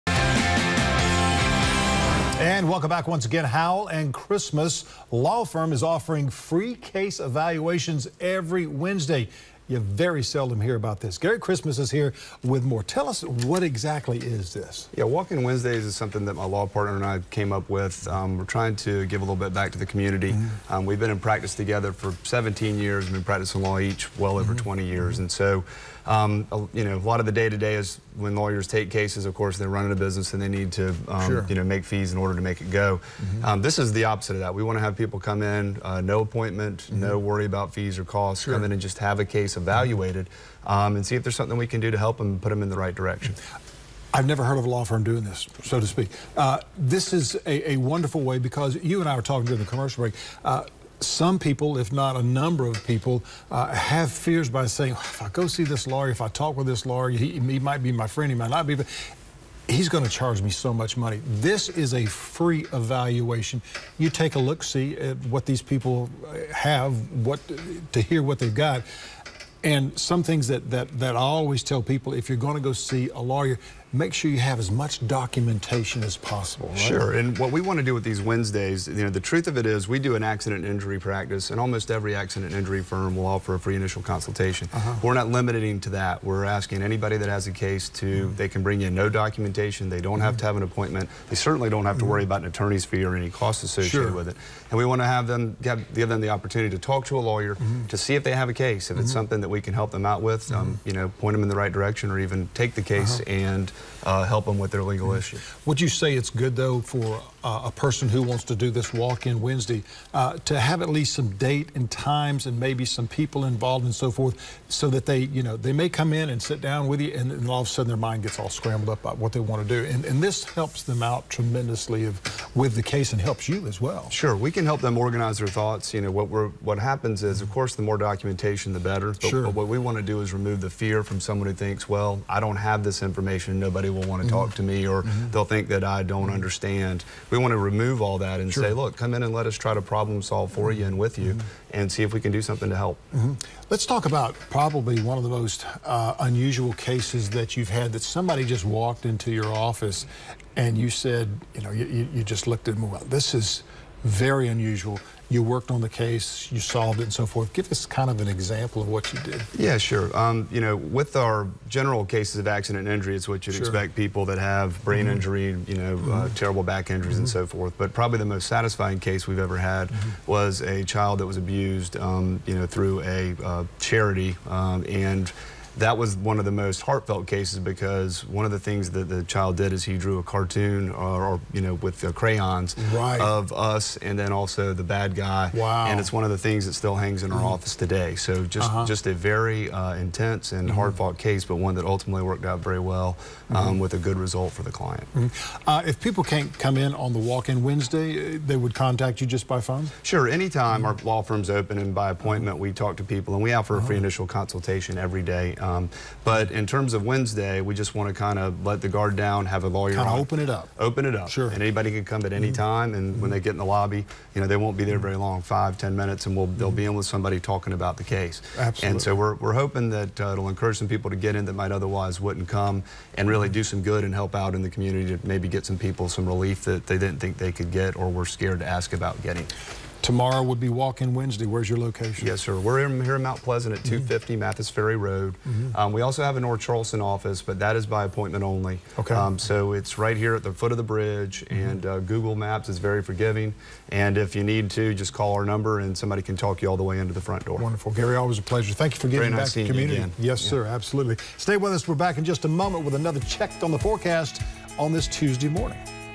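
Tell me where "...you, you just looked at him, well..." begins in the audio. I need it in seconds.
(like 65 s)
151 s.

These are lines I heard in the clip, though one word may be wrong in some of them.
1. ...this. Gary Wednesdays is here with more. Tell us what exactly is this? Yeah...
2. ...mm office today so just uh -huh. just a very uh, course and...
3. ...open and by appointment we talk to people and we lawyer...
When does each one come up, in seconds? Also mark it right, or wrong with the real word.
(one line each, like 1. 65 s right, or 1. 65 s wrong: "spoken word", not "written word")
1. 11 s wrong: "Christmas", not "Wednesdays"
2. 187 s wrong: "intense", not "course"
3. 201 s wrong: "offer", not "lawyer".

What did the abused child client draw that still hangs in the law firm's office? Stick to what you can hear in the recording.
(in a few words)
A cartoon.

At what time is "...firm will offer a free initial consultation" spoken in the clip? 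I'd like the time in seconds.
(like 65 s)
82 s.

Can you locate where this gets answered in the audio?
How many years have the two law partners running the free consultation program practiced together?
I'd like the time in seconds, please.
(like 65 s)
22 s.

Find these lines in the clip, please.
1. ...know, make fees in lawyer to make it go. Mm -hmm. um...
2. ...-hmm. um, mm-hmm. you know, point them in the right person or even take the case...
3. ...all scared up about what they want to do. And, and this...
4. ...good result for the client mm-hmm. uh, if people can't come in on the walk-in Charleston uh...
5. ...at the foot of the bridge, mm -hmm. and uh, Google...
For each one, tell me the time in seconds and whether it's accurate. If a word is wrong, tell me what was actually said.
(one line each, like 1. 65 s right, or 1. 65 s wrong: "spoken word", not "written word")
1. 31 s wrong: "order", not "lawyer"
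2. 100 s wrong: "direction", not "person"
3. 118 s wrong: "scrambled", not "scared"
4. 194 s wrong: "Wednesday", not "Charleston"
5. 240 s right.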